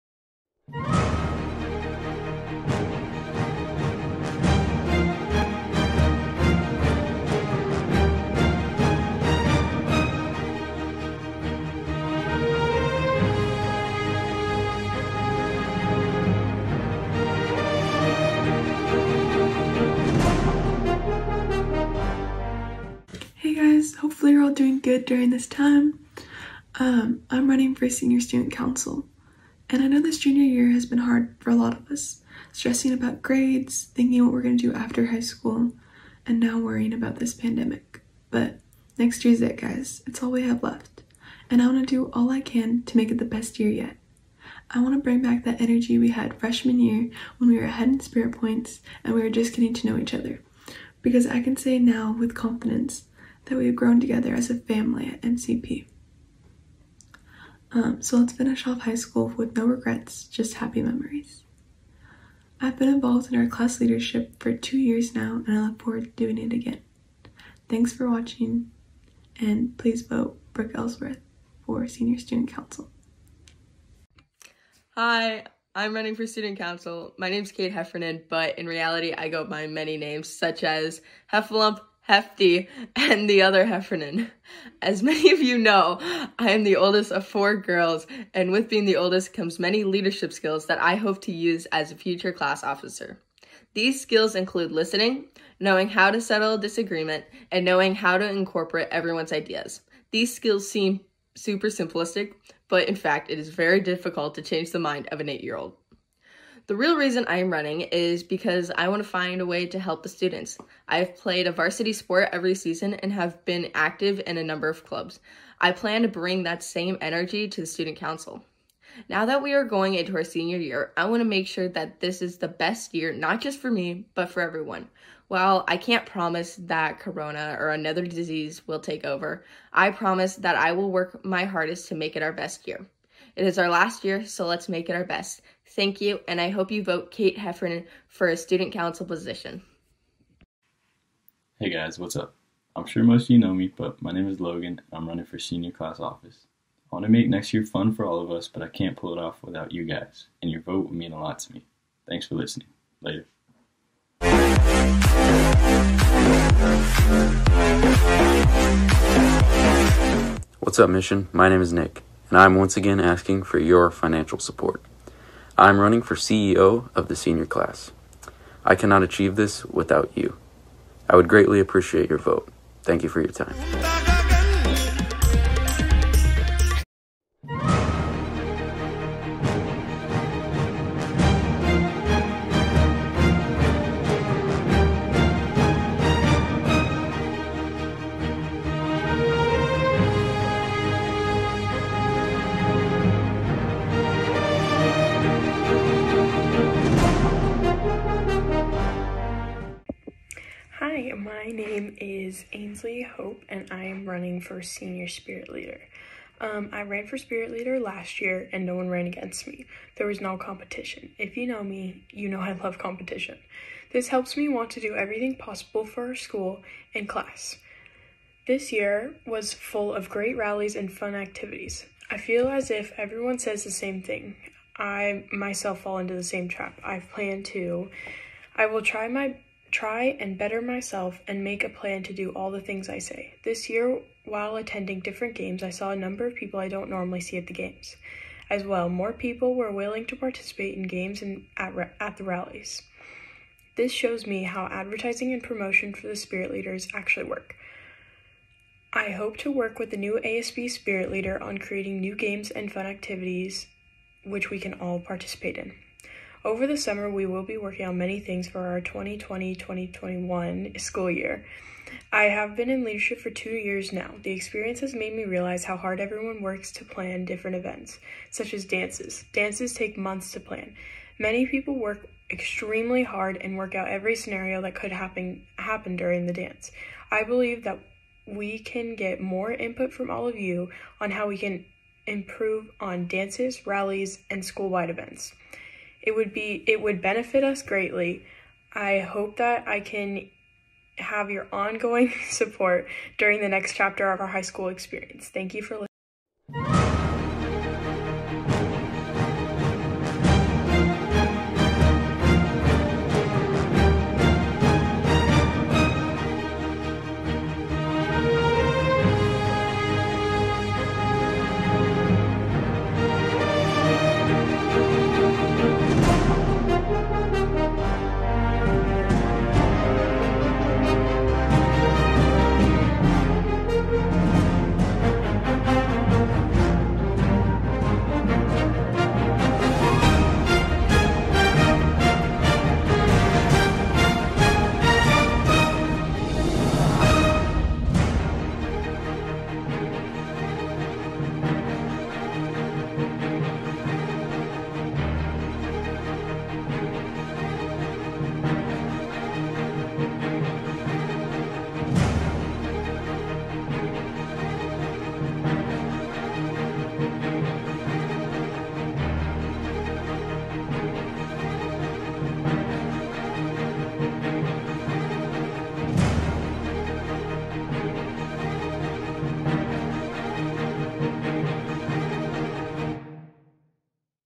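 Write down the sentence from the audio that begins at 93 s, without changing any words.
These skills include listening, knowing how to settle a disagreement, and knowing how to incorporate everyone's ideas.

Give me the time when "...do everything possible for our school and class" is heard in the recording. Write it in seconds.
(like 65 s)
214 s.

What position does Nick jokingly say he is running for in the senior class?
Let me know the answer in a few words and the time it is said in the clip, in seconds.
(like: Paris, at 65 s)
CEO, at 166 s.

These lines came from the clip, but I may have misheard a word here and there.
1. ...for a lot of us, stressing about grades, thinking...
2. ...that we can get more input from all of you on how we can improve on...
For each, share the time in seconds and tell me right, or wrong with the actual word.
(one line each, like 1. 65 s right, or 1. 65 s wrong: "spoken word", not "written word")
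1. 31 s right
2. 277 s right.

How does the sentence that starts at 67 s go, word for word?
Thanks for watching, and please vote Brooke Ellsworth for Senior Student Council.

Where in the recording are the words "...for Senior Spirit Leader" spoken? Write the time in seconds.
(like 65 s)
204 s.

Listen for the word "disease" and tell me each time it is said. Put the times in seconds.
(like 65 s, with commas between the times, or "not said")
128 s.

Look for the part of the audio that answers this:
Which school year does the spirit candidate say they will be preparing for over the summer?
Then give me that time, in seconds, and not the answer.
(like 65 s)
258 s.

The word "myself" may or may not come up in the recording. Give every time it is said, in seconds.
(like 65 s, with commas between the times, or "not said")
225 s, 230 s.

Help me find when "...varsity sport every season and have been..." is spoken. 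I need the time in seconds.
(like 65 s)
111 s.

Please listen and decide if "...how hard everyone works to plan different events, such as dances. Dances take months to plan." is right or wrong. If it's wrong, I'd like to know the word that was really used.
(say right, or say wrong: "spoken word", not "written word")
right.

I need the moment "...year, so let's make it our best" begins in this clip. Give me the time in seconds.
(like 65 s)
134 s.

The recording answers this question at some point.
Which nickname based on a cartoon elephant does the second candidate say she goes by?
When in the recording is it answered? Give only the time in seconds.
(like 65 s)
81 s.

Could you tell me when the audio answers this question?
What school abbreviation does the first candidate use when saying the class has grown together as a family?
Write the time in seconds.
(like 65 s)
55 s.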